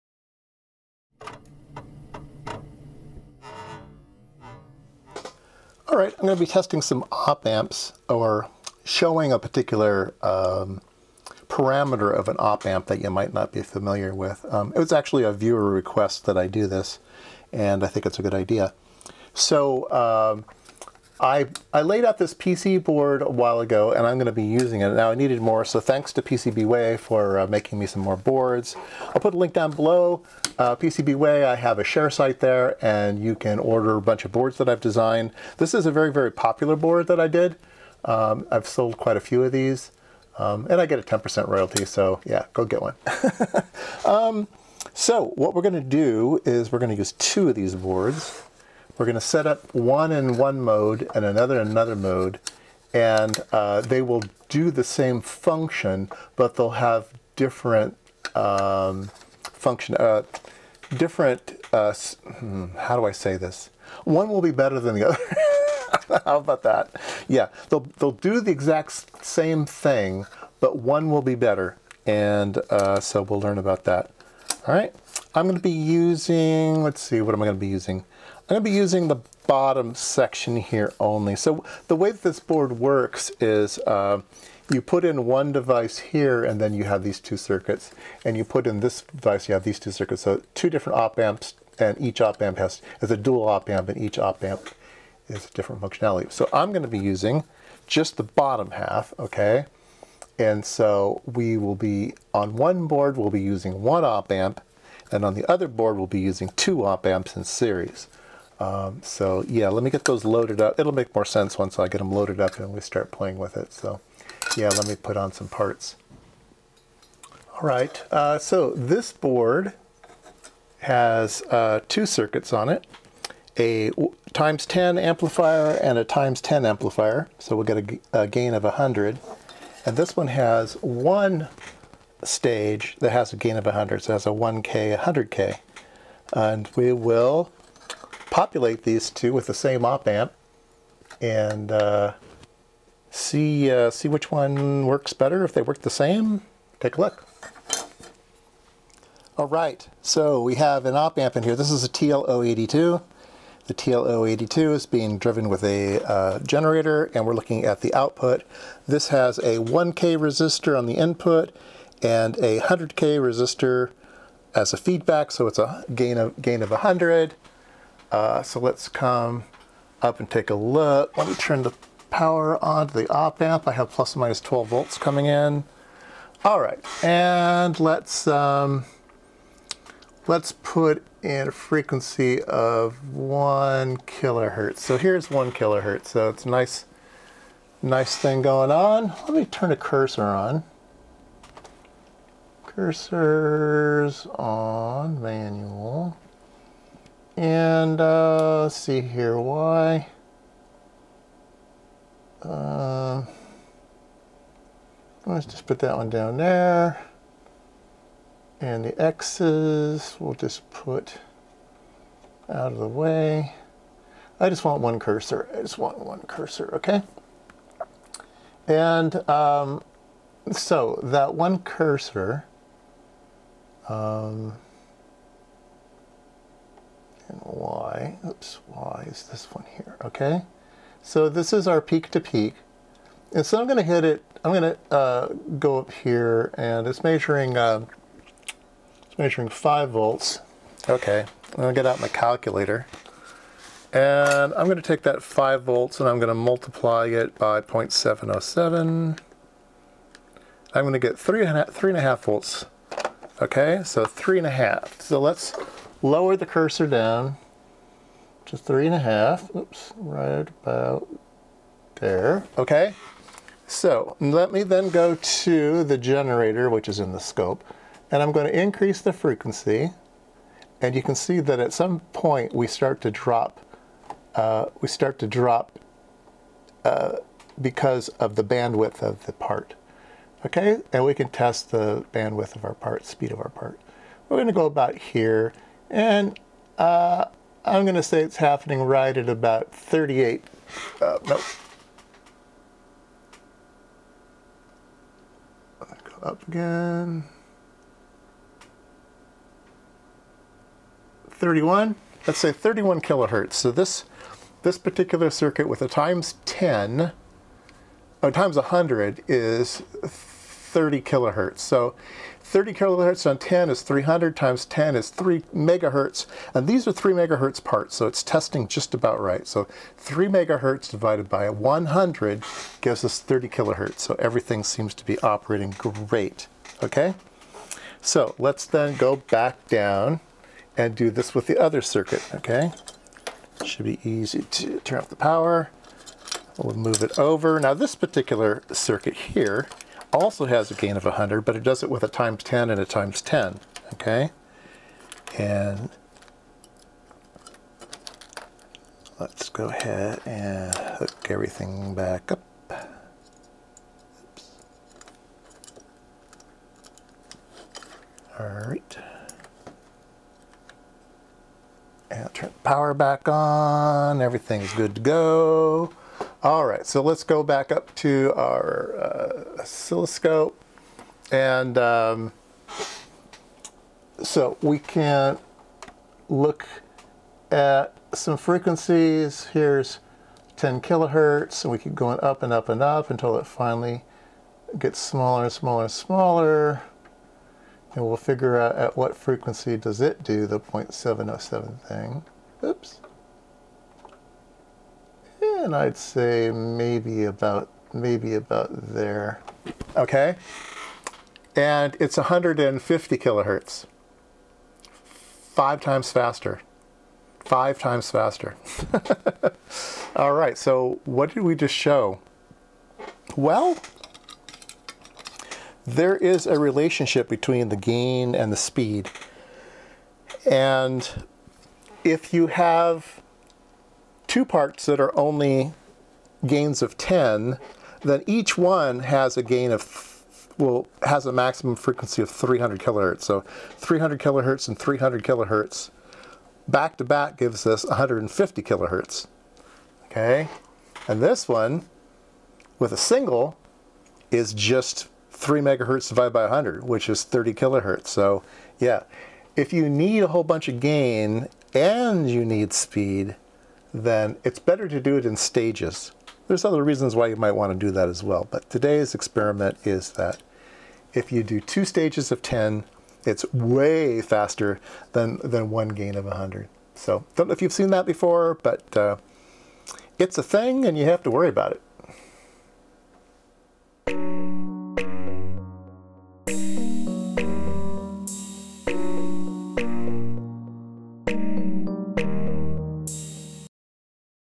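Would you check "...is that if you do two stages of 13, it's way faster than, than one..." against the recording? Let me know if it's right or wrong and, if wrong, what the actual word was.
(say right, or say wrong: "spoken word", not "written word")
wrong: "10", not "13".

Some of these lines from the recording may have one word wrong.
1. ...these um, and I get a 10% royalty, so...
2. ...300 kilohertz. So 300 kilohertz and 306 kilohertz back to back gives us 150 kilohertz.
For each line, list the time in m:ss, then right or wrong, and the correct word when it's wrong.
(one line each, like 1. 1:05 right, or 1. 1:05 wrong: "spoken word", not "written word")
1. 0:39 right
2. 7:12 wrong: "300", not "306".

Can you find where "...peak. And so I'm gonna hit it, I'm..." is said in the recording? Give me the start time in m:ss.
3:52.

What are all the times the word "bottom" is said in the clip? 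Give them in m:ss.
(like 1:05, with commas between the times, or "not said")
1:19, 1:38.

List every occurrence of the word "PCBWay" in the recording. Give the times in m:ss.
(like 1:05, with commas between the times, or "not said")
0:26, 0:30.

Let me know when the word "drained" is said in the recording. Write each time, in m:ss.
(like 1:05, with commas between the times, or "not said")
not said.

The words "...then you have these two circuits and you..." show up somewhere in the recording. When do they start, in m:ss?
1:26.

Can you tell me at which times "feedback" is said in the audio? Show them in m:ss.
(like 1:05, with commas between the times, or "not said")
2:44.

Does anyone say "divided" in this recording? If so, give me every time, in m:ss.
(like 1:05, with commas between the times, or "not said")
5:20, 7:26.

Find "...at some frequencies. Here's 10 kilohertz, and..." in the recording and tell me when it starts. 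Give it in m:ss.
6:17.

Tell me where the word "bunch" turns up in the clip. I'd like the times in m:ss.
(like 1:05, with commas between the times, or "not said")
0:34, 7:30.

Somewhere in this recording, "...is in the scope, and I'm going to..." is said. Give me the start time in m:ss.
4:26.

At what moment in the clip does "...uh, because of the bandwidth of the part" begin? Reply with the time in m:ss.
4:36.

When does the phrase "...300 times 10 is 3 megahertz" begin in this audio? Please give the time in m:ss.
5:13.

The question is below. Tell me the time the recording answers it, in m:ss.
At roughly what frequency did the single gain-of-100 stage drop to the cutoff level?
5:02.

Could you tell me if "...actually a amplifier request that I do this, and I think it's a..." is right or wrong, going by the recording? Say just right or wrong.
wrong.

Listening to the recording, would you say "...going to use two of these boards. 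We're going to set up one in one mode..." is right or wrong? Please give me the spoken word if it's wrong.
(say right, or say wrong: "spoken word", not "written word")
right.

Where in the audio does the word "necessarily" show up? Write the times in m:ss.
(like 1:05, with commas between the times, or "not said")
not said.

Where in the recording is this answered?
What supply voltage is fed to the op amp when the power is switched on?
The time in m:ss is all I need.
2:53.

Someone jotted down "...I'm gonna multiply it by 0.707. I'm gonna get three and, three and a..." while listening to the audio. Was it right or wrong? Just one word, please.
right.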